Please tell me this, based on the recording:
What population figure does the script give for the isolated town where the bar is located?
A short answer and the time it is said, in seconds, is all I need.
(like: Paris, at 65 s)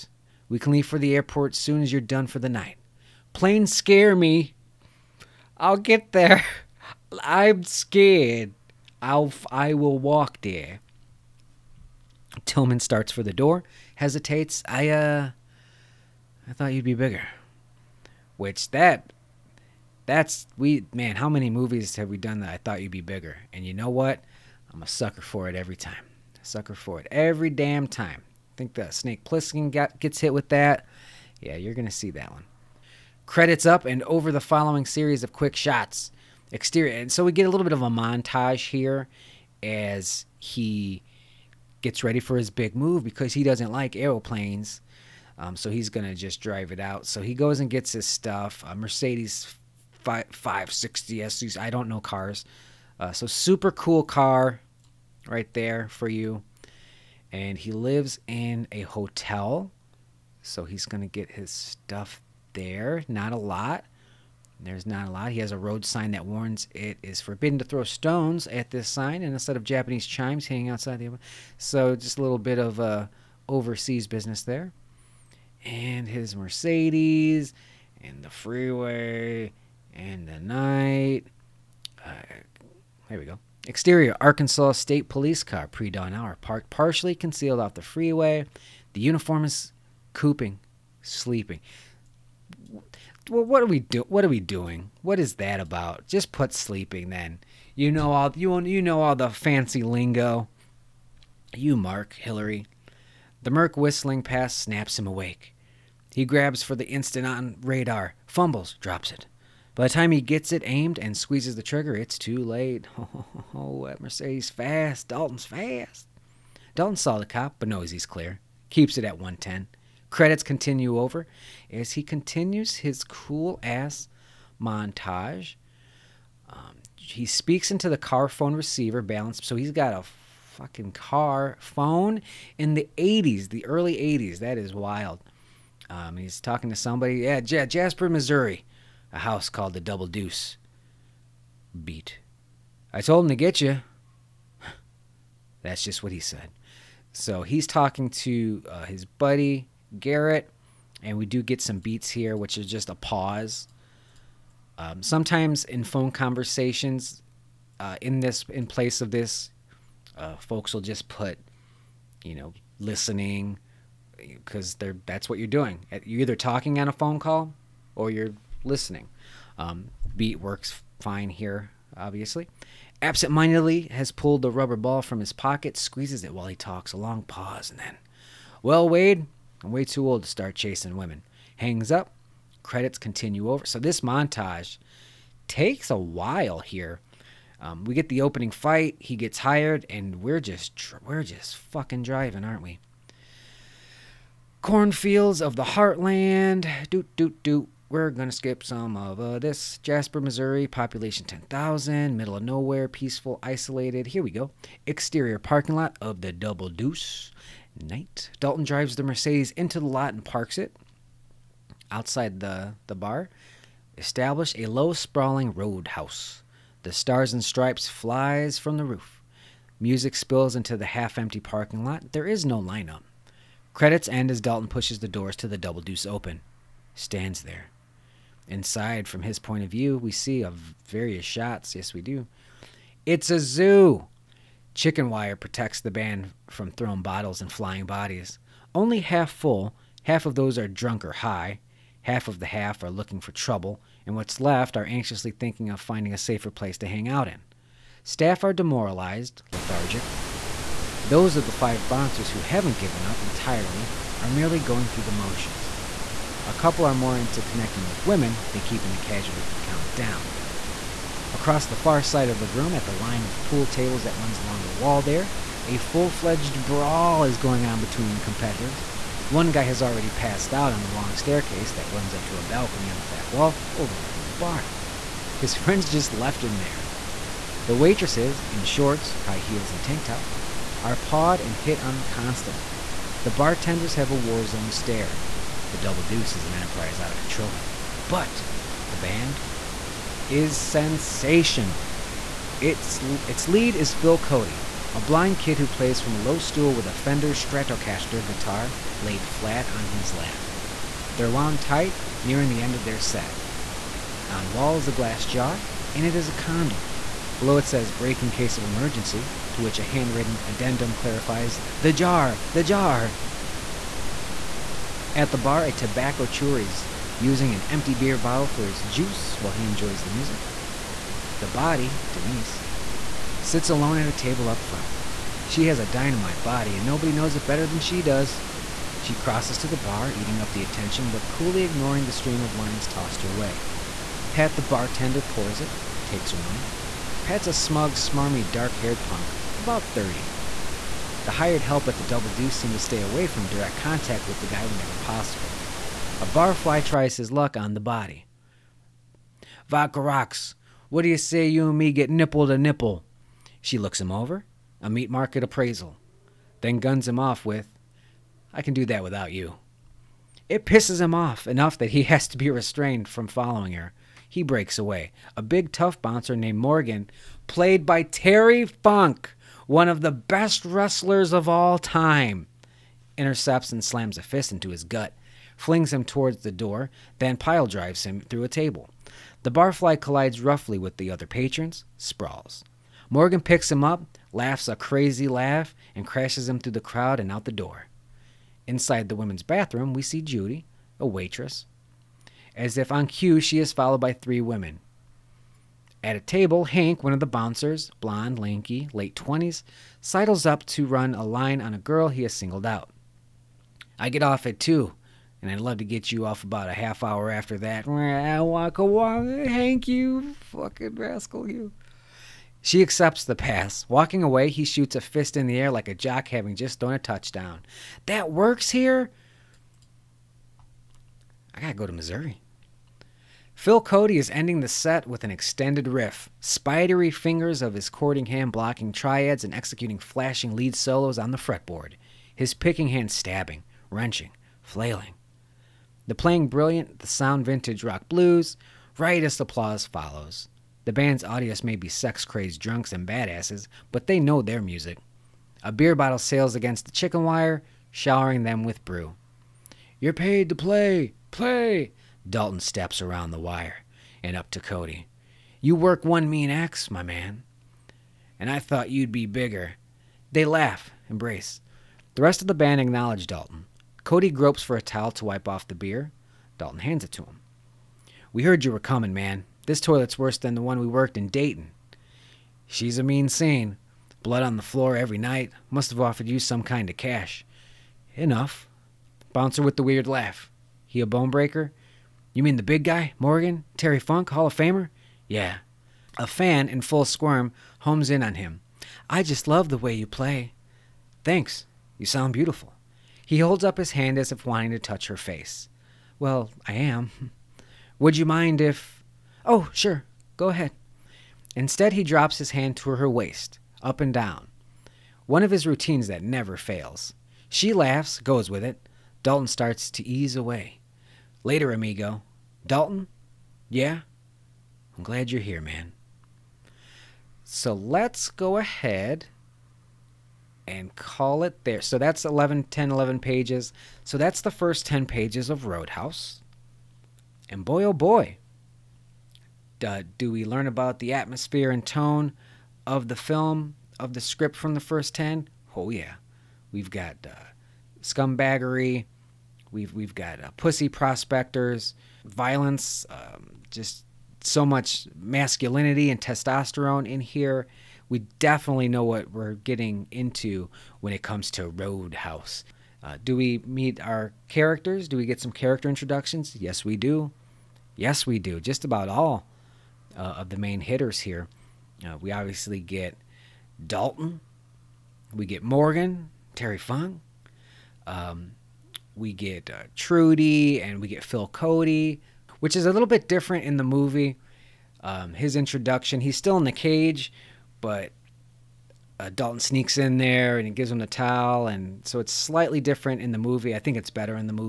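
10,000, at 201 s.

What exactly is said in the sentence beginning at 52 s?
Uh, so super cool car right there for you.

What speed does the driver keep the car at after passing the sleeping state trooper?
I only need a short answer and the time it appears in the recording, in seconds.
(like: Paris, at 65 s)
110, at 119 s.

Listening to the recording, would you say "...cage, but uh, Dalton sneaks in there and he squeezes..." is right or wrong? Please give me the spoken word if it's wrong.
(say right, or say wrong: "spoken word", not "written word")
wrong: "gives", not "squeezes".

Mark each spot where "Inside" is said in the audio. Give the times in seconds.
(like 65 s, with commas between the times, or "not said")
228 s, 388 s.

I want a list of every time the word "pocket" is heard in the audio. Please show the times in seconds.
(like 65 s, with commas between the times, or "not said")
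175 s.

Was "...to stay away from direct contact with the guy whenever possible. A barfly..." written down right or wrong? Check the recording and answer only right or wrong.
right.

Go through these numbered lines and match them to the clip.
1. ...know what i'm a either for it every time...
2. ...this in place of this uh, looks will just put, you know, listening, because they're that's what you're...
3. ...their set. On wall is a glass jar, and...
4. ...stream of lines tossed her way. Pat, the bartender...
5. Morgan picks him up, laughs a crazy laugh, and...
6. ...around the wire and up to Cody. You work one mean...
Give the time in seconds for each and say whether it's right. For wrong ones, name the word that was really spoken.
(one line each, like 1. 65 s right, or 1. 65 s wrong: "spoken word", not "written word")
1. 23 s wrong: "sucker", not "either"
2. 158 s wrong: "folks", not "looks"
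3. 302 s right
4. 332 s right
5. 383 s right
6. 453 s right.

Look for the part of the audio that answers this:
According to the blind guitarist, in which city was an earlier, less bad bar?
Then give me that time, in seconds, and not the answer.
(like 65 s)
471 s.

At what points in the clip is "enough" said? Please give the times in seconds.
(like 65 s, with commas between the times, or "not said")
361 s, 478 s.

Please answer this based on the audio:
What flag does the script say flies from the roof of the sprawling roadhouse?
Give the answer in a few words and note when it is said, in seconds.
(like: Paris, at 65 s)
The Stars and Stripes, at 216 s.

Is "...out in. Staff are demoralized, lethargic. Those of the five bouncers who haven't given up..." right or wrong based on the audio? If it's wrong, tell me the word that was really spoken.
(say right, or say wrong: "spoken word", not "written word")
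right.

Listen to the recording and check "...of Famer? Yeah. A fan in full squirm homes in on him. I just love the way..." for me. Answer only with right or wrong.
right.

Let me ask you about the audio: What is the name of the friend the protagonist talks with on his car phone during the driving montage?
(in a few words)
Garrett.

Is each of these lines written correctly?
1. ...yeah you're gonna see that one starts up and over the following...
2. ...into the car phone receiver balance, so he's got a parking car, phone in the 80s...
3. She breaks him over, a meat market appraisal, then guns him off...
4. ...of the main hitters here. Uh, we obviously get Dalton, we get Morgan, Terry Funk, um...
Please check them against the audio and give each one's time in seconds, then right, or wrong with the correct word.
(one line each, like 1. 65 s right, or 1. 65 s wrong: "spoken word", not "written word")
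1. 31 s wrong: "credits", not "starts"
2. 127 s wrong: "fucking", not "parking"
3. 353 s wrong: "looks", not "breaks"
4. 560 s right.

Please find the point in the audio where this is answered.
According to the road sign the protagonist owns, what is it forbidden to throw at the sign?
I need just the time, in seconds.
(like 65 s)
67 s.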